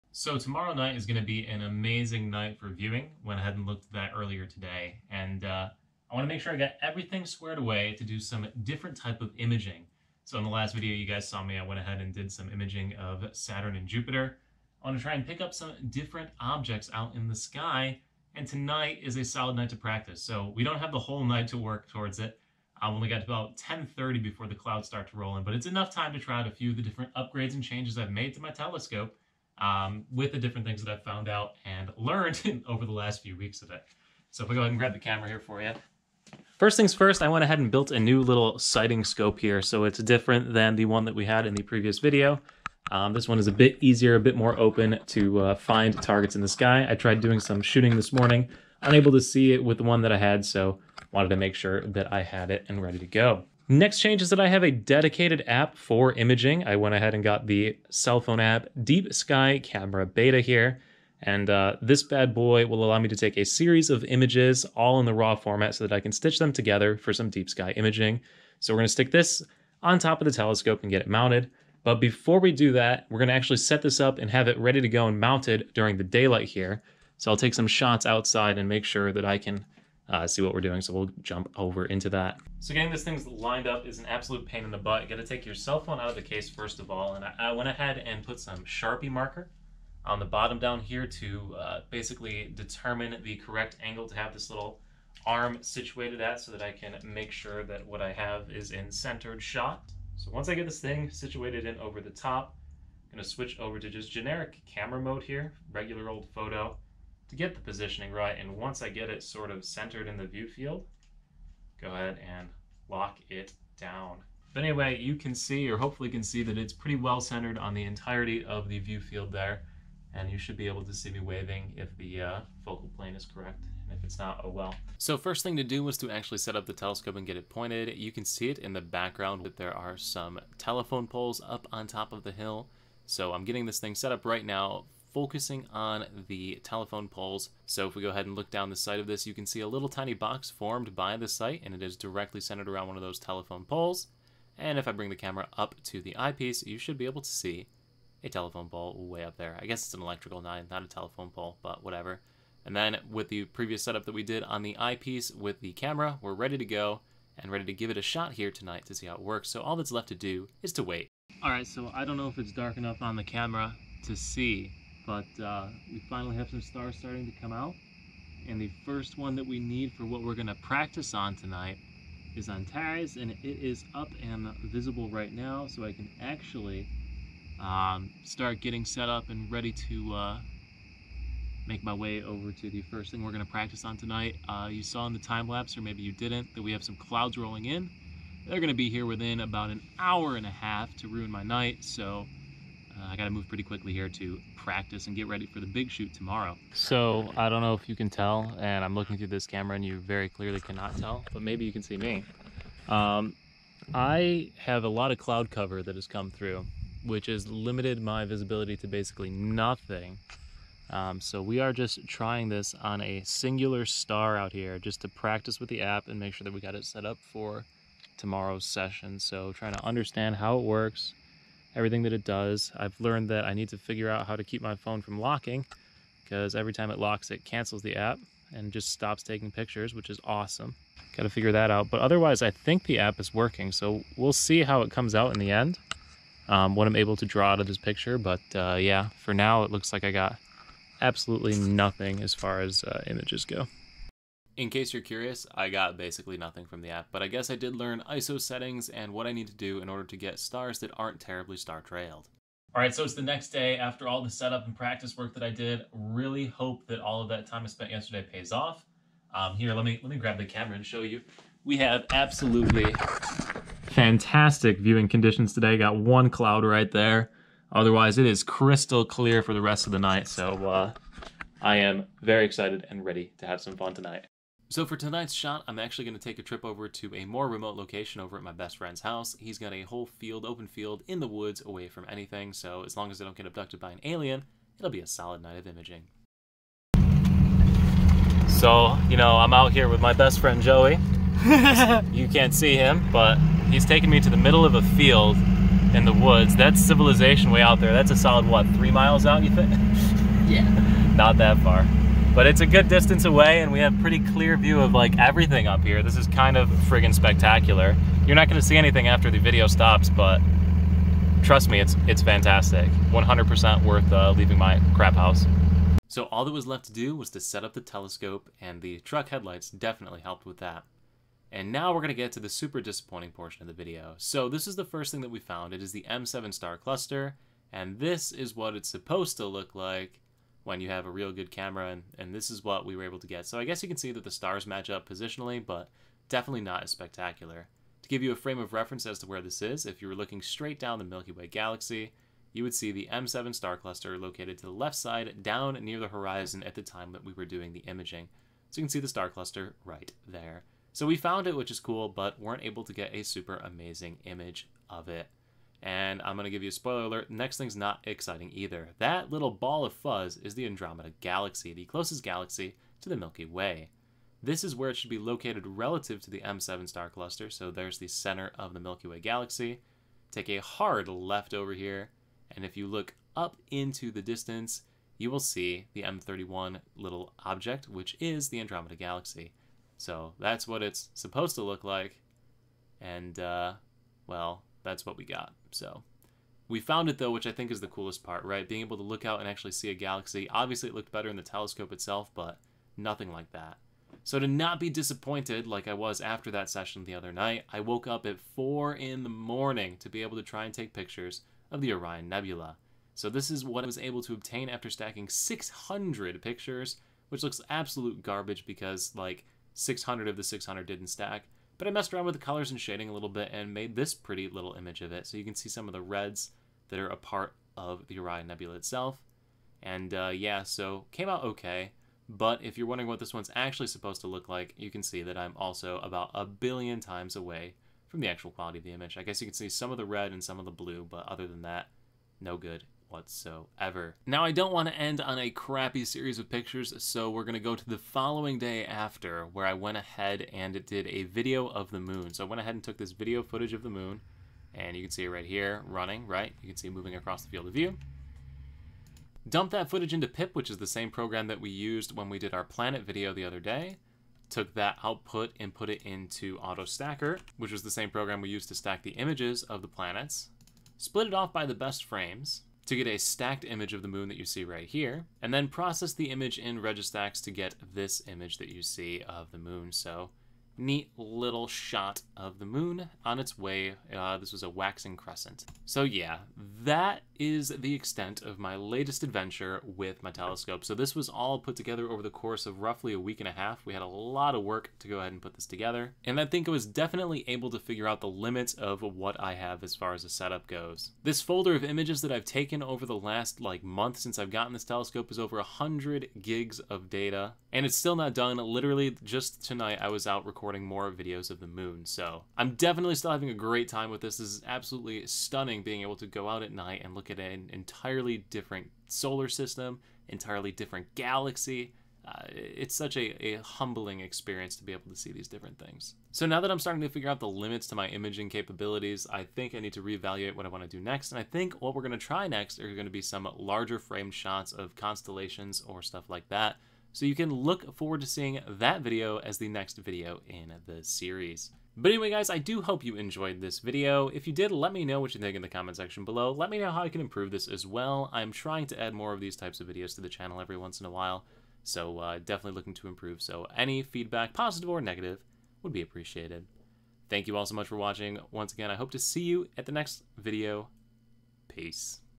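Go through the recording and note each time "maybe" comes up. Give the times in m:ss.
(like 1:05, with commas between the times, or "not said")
3:05, 3:21.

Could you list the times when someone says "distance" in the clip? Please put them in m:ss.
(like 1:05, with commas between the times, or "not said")
5:02, 6:14.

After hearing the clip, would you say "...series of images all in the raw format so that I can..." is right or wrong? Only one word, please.
right.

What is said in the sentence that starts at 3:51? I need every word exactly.
But otherwise, I think the app is working.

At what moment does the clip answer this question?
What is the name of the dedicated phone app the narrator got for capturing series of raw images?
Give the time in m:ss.
0:58.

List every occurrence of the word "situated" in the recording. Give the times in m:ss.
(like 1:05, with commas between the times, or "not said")
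1:35, 1:41.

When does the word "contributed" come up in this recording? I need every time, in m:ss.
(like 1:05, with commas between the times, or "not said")
not said.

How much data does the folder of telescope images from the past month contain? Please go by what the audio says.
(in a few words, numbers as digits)
over 100 gigs.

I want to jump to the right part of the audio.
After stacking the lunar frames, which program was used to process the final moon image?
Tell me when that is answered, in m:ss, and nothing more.
7:46.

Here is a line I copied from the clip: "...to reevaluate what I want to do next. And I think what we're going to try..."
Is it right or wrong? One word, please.
right.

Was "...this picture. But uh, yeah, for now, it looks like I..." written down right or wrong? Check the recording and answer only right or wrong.
right.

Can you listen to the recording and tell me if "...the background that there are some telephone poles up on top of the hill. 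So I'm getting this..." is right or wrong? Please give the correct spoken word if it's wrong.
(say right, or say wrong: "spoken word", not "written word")
right.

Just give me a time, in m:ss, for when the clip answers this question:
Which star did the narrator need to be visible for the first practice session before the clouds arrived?
2:52.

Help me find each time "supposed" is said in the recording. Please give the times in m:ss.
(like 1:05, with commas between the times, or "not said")
5:28, 6:21, 7:03.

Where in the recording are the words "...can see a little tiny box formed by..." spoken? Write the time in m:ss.
2:19.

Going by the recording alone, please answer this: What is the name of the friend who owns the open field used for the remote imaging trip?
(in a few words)
Joey.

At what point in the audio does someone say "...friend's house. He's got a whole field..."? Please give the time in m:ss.
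4:38.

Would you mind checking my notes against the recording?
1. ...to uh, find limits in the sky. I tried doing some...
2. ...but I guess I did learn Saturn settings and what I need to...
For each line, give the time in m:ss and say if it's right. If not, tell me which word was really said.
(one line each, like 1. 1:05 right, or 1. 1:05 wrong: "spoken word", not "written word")
1. 0:45 wrong: "targets", not "limits"
2. 4:07 wrong: "ISO", not "Saturn".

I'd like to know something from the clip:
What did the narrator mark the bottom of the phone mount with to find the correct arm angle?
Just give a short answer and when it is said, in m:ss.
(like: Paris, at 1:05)
Sharpie marker, at 1:28.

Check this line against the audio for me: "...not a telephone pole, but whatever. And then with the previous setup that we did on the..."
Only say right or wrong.
right.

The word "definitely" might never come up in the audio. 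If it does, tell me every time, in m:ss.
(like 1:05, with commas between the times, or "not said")
5:19, 5:36, 8:06, 8:22, 9:02.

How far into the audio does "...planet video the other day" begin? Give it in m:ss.
7:32.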